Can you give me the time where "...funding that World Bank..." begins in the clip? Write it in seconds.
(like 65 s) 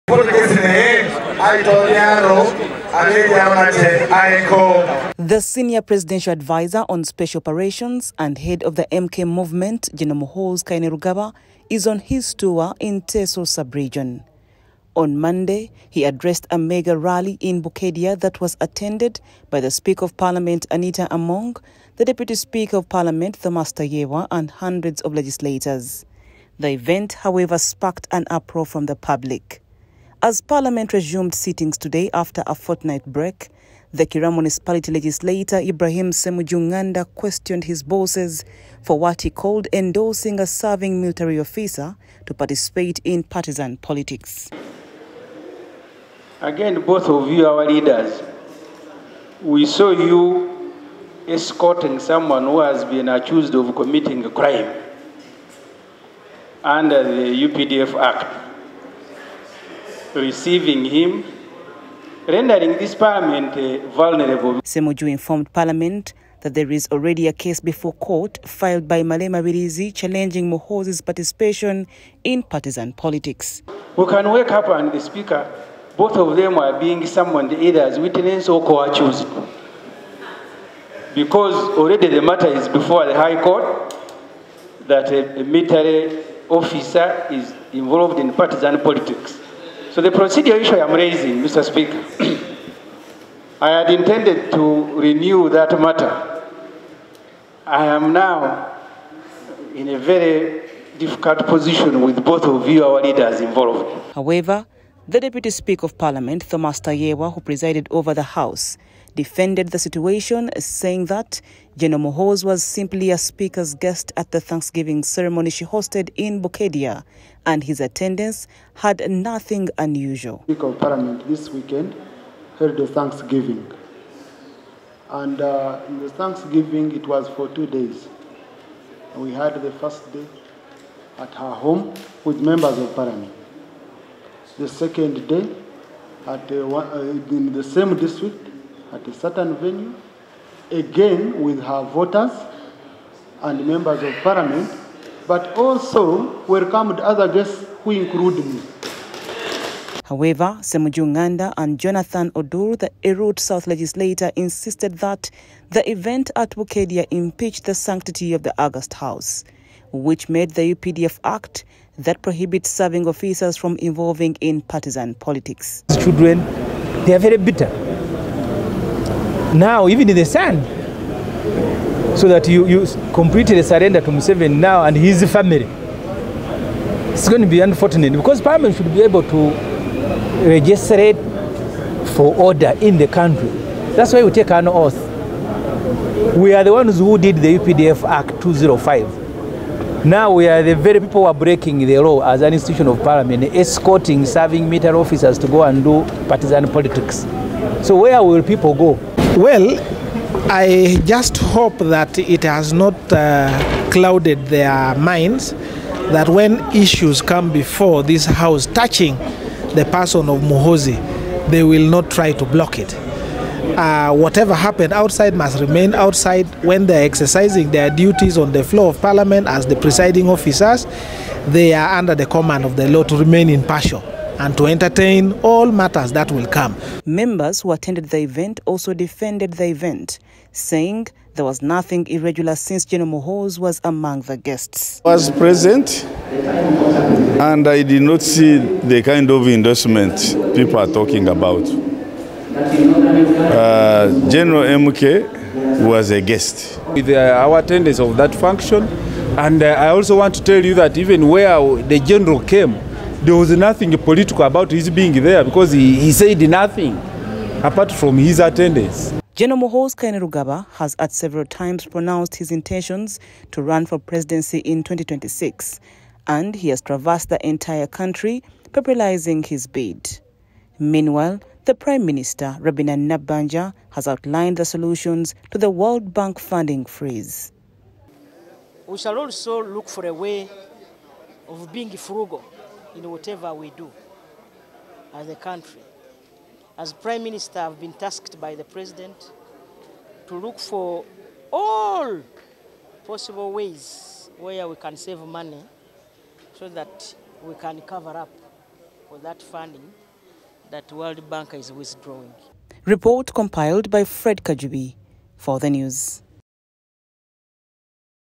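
299 s.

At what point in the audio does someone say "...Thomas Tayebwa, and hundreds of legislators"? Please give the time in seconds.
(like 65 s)
23 s.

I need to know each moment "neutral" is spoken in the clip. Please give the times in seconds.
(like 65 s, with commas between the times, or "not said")
not said.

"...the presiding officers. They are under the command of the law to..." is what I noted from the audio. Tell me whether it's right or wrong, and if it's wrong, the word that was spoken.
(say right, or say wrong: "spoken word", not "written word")
right.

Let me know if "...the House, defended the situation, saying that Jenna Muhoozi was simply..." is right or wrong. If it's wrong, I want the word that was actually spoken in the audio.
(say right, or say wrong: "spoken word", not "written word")
right.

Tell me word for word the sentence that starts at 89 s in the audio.
So the procedure issue I'm raising, Mr.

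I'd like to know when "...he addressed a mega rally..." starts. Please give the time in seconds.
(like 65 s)
15 s.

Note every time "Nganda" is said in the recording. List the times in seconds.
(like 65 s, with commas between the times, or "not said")
36 s, 151 s.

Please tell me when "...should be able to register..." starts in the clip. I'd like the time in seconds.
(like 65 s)
178 s.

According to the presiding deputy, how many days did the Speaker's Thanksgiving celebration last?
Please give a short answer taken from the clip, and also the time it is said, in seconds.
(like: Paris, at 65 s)
2, at 127 s.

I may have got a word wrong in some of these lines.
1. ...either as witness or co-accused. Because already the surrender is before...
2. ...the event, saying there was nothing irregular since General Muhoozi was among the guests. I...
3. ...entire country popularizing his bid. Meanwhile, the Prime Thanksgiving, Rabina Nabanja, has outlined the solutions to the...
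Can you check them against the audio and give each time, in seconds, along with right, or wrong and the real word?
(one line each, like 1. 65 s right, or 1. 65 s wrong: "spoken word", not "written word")
1. 77 s wrong: "matter", not "surrender"
2. 229 s right
3. 267 s wrong: "Minister", not "Thanksgiving".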